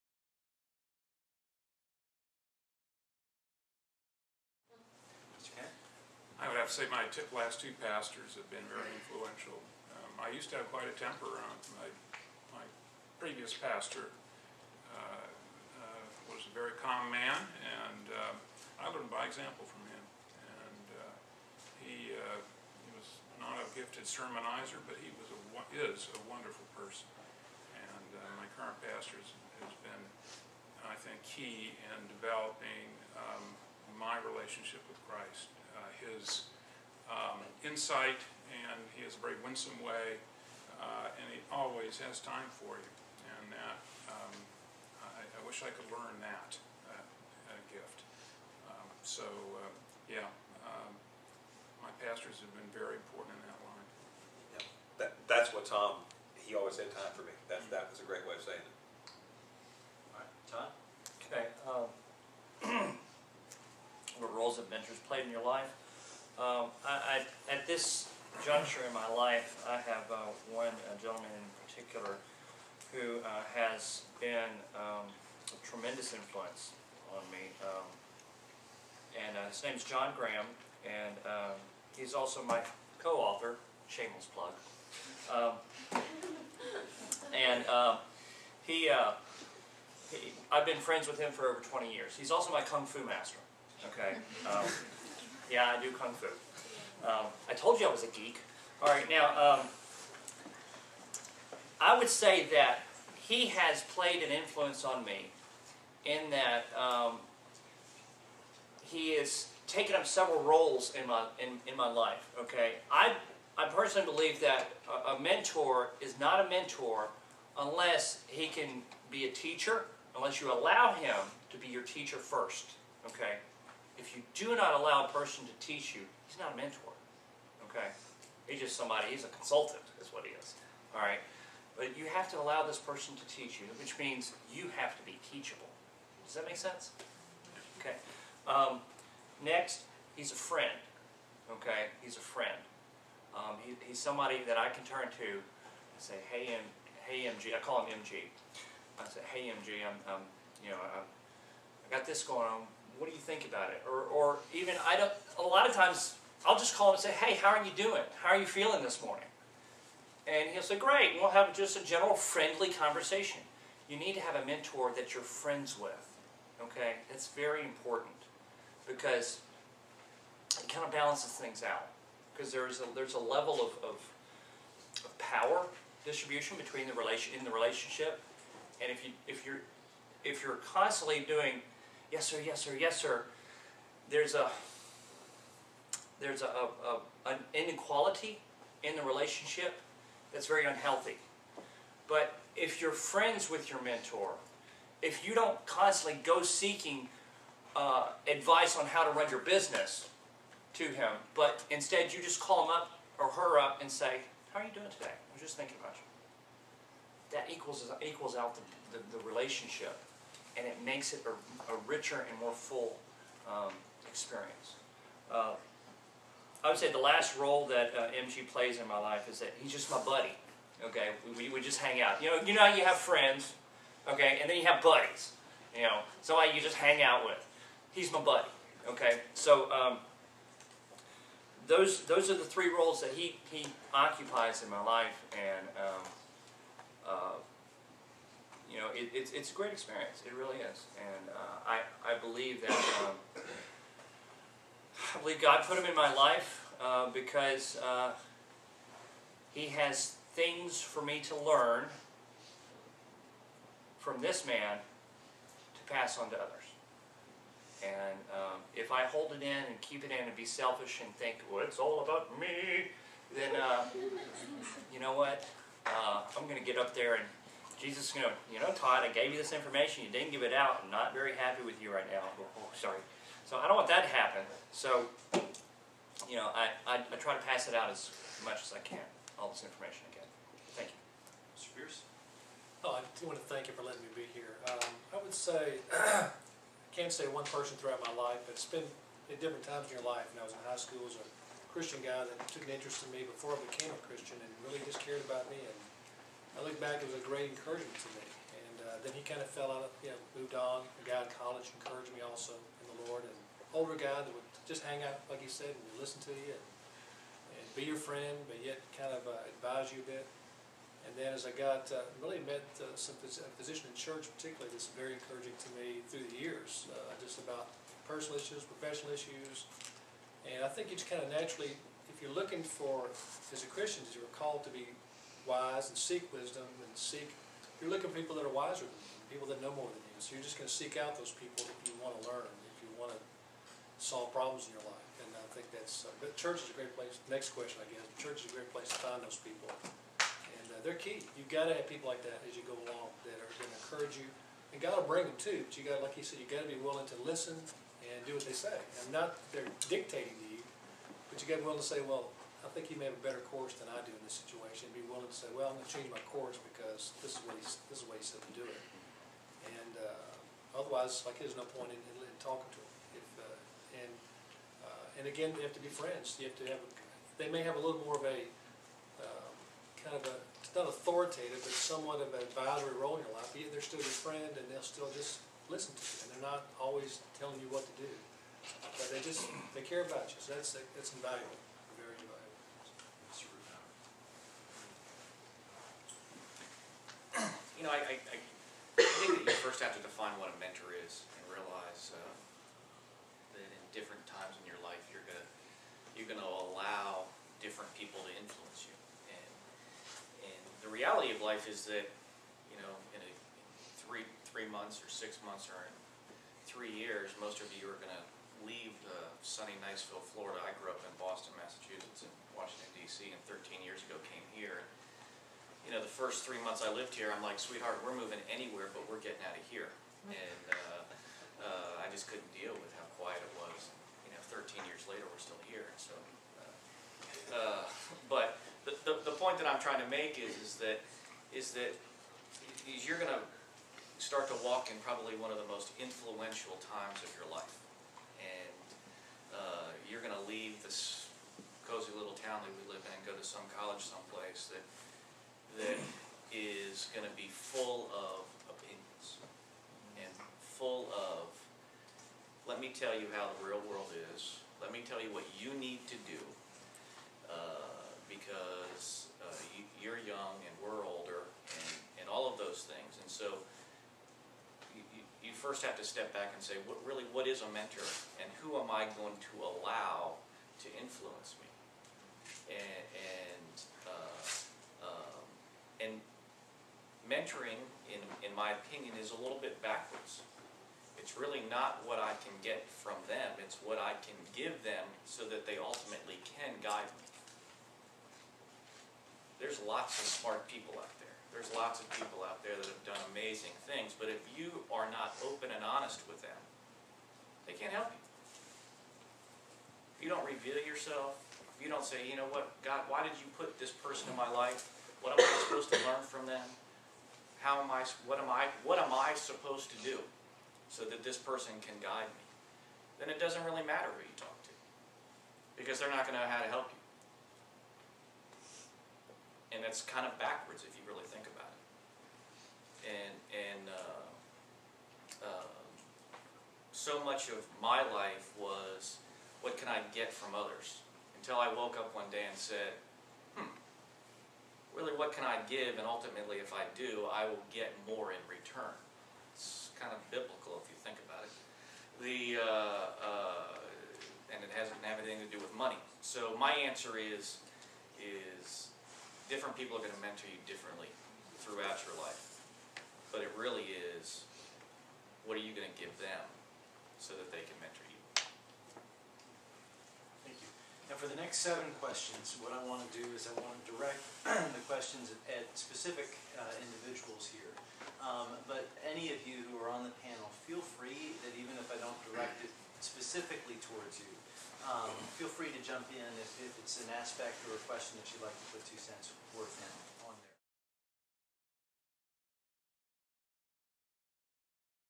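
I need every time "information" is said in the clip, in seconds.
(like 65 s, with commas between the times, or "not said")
269 s, 279 s.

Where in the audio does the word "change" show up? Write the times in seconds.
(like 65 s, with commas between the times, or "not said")
355 s.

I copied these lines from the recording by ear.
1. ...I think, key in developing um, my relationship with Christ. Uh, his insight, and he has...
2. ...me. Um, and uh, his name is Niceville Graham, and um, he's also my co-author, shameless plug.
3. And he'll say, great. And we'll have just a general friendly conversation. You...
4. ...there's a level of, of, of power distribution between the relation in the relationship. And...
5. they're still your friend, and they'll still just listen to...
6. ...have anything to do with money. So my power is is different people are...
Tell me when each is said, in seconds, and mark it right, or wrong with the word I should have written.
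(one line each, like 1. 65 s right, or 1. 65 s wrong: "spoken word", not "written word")
1. 30 s right
2. 77 s wrong: "John", not "Niceville"
3. 160 s right
4. 172 s right
5. 373 s right
6. 545 s wrong: "answer", not "power".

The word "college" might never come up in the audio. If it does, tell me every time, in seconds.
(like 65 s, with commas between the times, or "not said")
301 s, 443 s.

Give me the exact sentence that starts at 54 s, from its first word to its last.
Yeah, that, that's what Tom, he always had time for me.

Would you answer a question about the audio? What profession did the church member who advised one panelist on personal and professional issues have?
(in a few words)
physician.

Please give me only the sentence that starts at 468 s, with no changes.
And who am I going to allow to influence me?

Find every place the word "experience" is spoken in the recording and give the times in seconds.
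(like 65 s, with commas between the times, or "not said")
214 s, 239 s.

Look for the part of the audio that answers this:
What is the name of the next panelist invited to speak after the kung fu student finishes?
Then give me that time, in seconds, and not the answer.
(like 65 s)
281 s.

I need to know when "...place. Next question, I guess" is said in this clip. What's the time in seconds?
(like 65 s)
336 s.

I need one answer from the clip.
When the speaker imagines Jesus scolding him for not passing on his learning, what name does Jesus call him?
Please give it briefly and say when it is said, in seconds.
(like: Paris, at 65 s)
Todd, at 268 s.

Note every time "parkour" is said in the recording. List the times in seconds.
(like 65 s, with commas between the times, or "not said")
not said.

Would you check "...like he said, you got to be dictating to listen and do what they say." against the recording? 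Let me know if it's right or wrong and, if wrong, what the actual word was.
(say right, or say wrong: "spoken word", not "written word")
wrong: "willing", not "dictating".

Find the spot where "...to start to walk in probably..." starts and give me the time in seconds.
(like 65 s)
433 s.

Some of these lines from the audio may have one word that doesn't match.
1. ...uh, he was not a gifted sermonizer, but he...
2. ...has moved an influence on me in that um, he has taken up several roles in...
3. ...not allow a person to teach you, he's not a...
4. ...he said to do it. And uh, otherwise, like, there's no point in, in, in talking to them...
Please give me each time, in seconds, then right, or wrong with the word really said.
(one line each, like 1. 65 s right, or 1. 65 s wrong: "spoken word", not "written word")
1. 22 s right
2. 103 s wrong: "played", not "moved"
3. 124 s right
4. 358 s right.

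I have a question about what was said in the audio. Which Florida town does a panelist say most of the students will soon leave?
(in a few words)
Niceville.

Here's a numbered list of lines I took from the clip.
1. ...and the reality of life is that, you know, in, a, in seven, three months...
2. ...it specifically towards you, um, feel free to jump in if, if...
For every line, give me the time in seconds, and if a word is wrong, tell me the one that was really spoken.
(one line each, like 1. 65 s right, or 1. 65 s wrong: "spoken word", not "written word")
1. 400 s wrong: "three", not "seven"
2. 572 s right.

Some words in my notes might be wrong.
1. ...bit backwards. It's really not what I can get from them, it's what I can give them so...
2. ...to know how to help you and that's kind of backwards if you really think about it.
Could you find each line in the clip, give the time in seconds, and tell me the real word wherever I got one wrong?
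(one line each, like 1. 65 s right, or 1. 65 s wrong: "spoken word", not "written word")
1. 479 s right
2. 516 s right.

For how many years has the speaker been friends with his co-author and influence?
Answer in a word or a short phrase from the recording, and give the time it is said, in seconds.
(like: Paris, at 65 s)
over 20 years, at 91 s.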